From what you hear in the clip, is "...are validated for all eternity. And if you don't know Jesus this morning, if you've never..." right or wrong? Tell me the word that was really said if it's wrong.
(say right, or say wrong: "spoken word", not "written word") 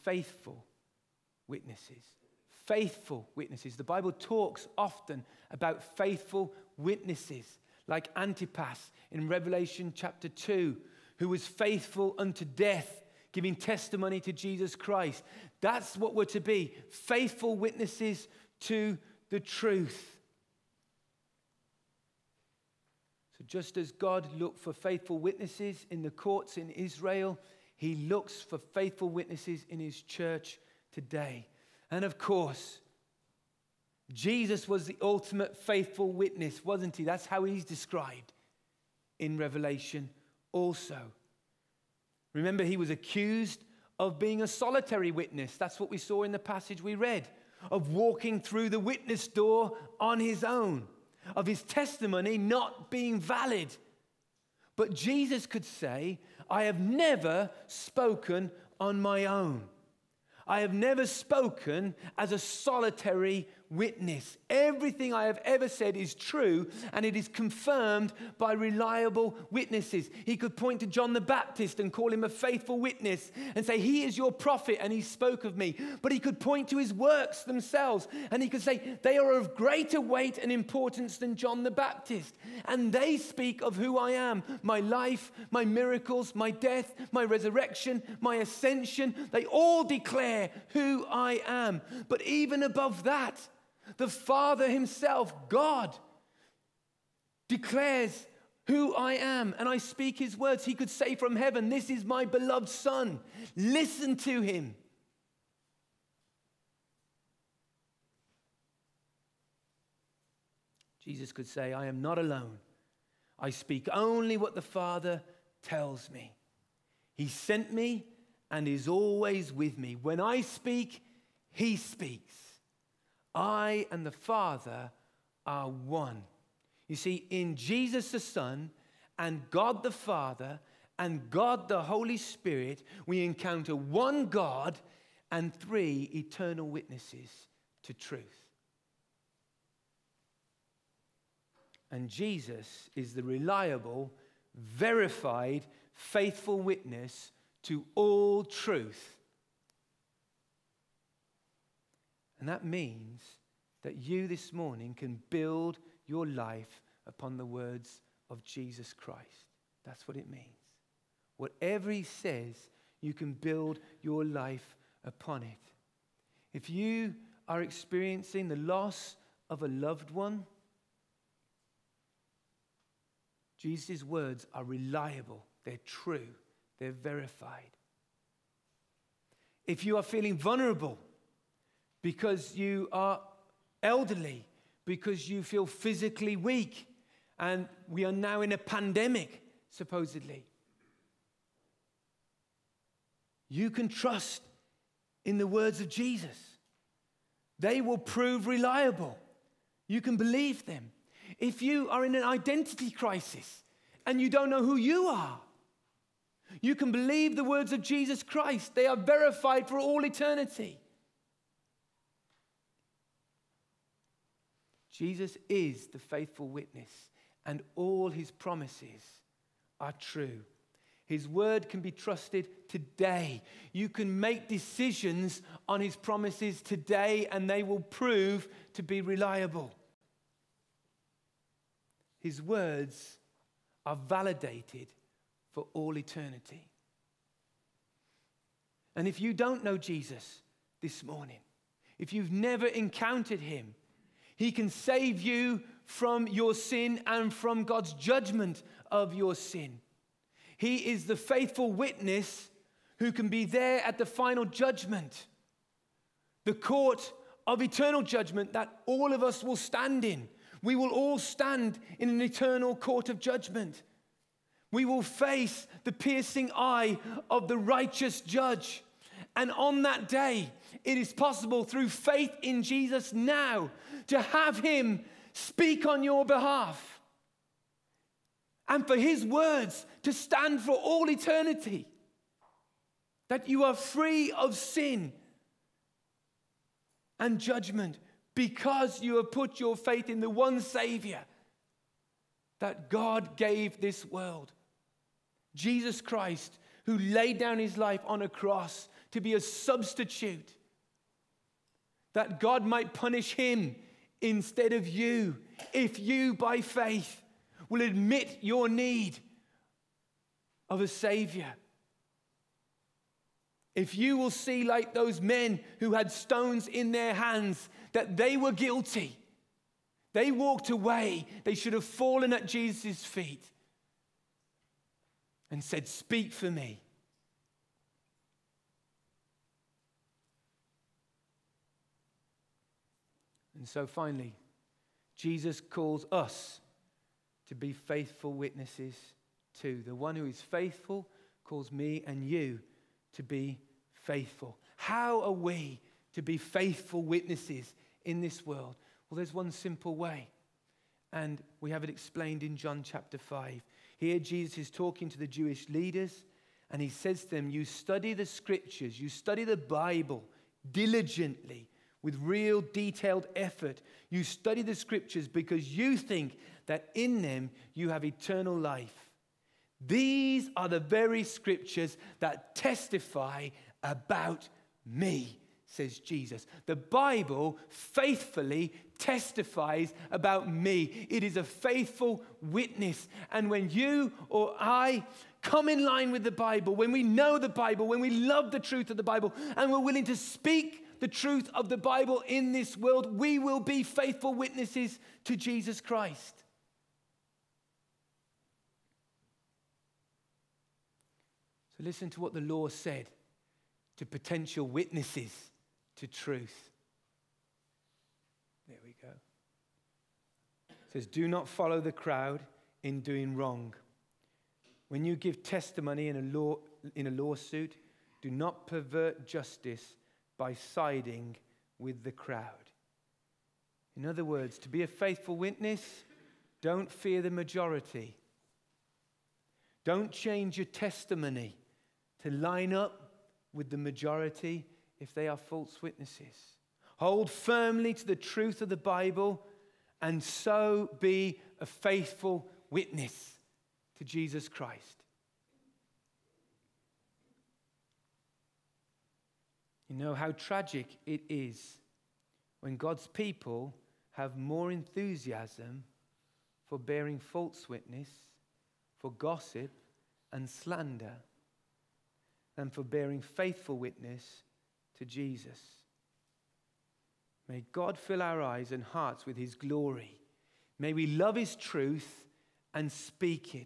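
right.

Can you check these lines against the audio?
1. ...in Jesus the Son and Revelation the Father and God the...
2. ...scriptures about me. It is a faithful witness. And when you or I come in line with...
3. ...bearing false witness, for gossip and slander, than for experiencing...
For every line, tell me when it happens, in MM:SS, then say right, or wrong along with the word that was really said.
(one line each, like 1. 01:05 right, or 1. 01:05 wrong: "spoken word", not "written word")
1. 02:07 wrong: "God", not "Revelation"
2. 06:18 wrong: "testifies", not "scriptures"
3. 07:36 wrong: "bearing", not "experiencing".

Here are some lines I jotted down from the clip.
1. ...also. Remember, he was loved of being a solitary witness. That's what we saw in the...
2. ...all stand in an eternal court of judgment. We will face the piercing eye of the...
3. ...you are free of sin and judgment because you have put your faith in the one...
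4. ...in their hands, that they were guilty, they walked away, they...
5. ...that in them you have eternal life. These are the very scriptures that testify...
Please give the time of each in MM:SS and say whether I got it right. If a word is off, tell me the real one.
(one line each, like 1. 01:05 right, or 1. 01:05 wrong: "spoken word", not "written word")
1. 00:40 wrong: "accused", not "loved"
2. 04:20 right
3. 04:43 right
4. 05:16 right
5. 06:06 right.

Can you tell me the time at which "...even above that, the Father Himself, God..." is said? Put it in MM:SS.
01:32.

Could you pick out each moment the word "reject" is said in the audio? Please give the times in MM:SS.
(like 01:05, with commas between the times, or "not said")
not said.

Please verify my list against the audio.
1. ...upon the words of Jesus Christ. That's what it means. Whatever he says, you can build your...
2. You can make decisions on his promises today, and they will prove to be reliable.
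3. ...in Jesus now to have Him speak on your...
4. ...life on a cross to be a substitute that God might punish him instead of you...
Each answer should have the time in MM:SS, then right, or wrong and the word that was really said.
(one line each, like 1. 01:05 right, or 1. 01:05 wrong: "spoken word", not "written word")
1. 02:37 right
2. 03:43 right
3. 04:32 right
4. 04:57 right.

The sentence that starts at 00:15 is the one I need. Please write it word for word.
That's what we're to be faithful witnesses to the truth.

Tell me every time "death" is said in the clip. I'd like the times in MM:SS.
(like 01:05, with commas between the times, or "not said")
00:12, 01:26.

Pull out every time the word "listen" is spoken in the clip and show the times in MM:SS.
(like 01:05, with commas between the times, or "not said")
01:43, 06:41.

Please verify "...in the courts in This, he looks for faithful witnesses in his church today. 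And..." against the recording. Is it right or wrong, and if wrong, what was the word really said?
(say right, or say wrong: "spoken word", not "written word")
wrong: "Israel", not "This".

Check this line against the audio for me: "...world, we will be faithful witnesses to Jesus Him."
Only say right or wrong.
wrong.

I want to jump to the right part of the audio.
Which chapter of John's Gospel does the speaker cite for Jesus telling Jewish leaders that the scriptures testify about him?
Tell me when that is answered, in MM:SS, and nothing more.
05:52.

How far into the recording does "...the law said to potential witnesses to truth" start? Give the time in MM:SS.
06:42.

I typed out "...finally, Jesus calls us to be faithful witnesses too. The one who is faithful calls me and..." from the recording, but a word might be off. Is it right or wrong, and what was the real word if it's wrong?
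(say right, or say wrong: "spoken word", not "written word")
right.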